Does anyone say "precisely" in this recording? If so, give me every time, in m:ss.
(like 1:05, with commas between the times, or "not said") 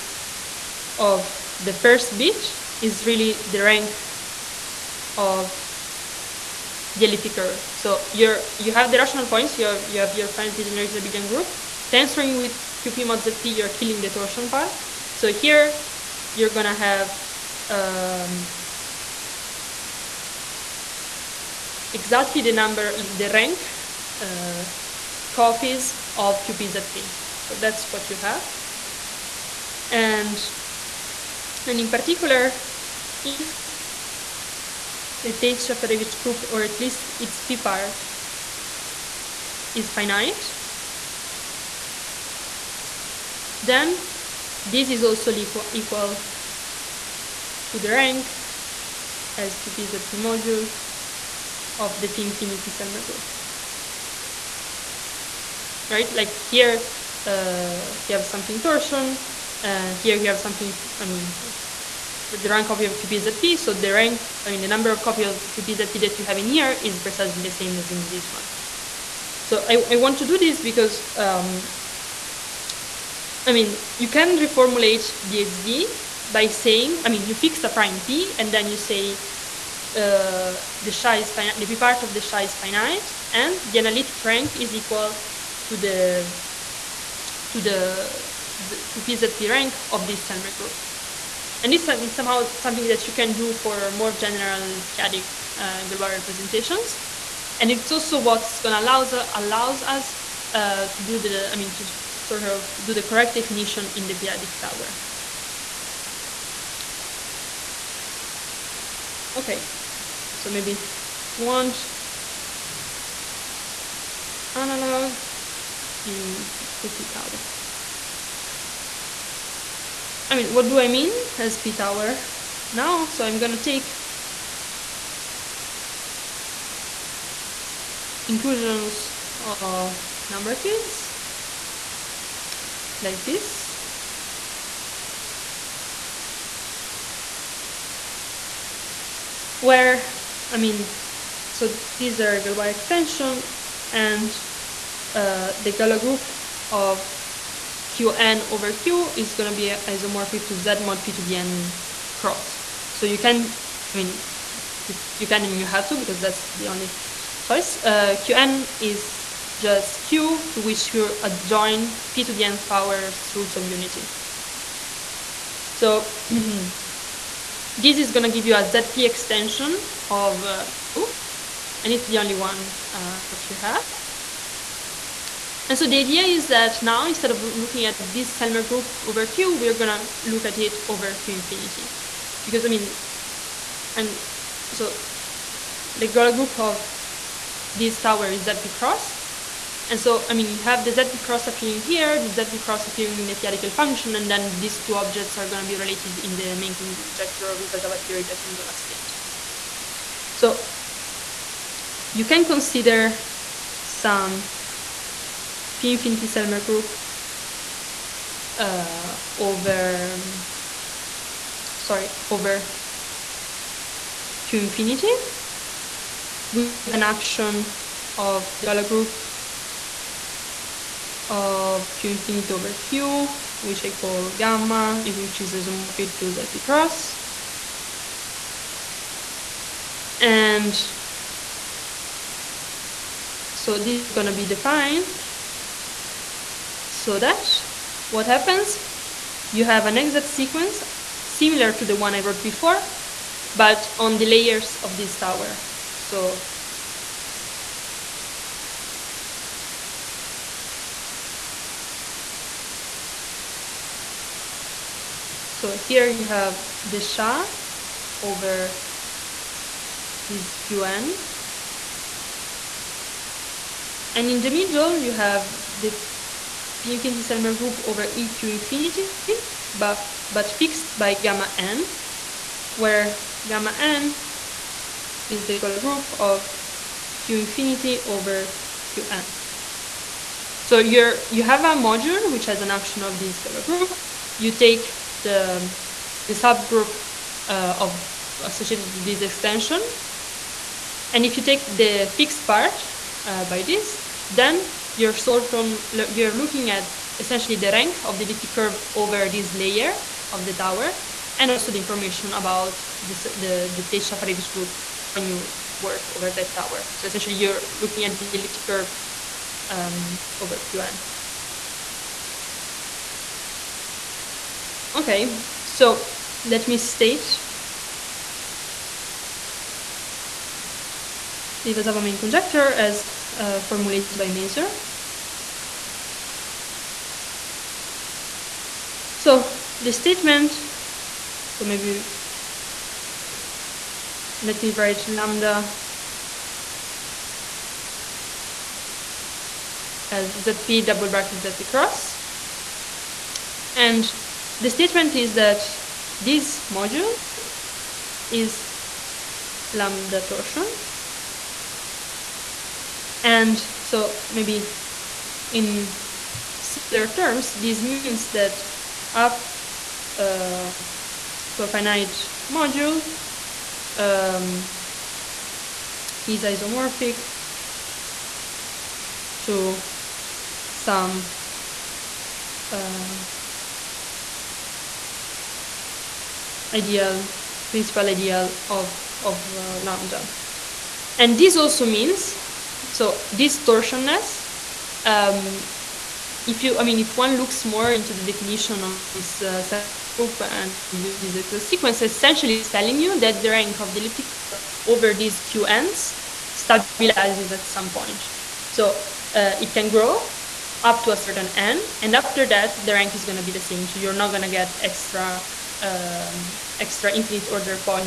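1:06.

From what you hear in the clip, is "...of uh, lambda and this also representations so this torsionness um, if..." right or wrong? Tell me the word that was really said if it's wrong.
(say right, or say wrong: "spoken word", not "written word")
wrong: "means", not "representations".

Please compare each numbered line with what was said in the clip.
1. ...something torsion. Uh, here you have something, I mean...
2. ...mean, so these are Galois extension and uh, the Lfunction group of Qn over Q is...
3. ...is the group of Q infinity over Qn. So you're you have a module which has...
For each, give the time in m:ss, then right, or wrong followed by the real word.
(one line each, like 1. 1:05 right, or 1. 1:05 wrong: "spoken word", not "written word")
1. 0:58 right
2. 2:20 wrong: "Galois", not "Lfunction"
3. 4:35 right.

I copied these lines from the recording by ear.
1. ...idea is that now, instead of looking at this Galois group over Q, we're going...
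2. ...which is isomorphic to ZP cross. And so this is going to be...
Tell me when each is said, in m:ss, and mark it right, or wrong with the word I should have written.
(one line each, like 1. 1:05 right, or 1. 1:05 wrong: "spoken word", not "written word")
1. 2:55 wrong: "Selmer", not "Galois"
2. 3:45 right.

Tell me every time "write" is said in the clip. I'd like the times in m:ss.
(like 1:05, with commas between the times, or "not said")
5:34.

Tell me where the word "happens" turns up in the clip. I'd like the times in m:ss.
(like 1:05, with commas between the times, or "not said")
3:58.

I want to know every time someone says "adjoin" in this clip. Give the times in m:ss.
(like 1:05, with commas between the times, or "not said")
2:41.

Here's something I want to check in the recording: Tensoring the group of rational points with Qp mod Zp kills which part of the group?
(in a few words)
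The torsion part.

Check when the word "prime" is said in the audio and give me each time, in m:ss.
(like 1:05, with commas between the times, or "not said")
1:17.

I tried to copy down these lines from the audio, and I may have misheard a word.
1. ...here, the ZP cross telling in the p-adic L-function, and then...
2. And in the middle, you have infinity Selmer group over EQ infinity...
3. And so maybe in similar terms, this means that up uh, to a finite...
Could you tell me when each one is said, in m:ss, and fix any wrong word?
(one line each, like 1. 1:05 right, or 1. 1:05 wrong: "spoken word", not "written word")
1. 3:11 wrong: "appearing", not "telling"
2. 4:24 right
3. 5:53 right.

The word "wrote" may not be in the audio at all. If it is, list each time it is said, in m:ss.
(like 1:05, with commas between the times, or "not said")
4:02.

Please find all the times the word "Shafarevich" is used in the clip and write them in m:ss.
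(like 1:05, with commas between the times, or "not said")
0:35, 5:03.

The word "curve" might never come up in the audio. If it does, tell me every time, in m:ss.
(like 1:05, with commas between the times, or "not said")
0:07, 4:58, 5:08, 6:34.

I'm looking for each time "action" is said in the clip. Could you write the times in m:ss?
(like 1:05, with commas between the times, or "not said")
3:37, 4:42.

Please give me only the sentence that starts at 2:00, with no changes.
I mean, what do I mean as p tower now?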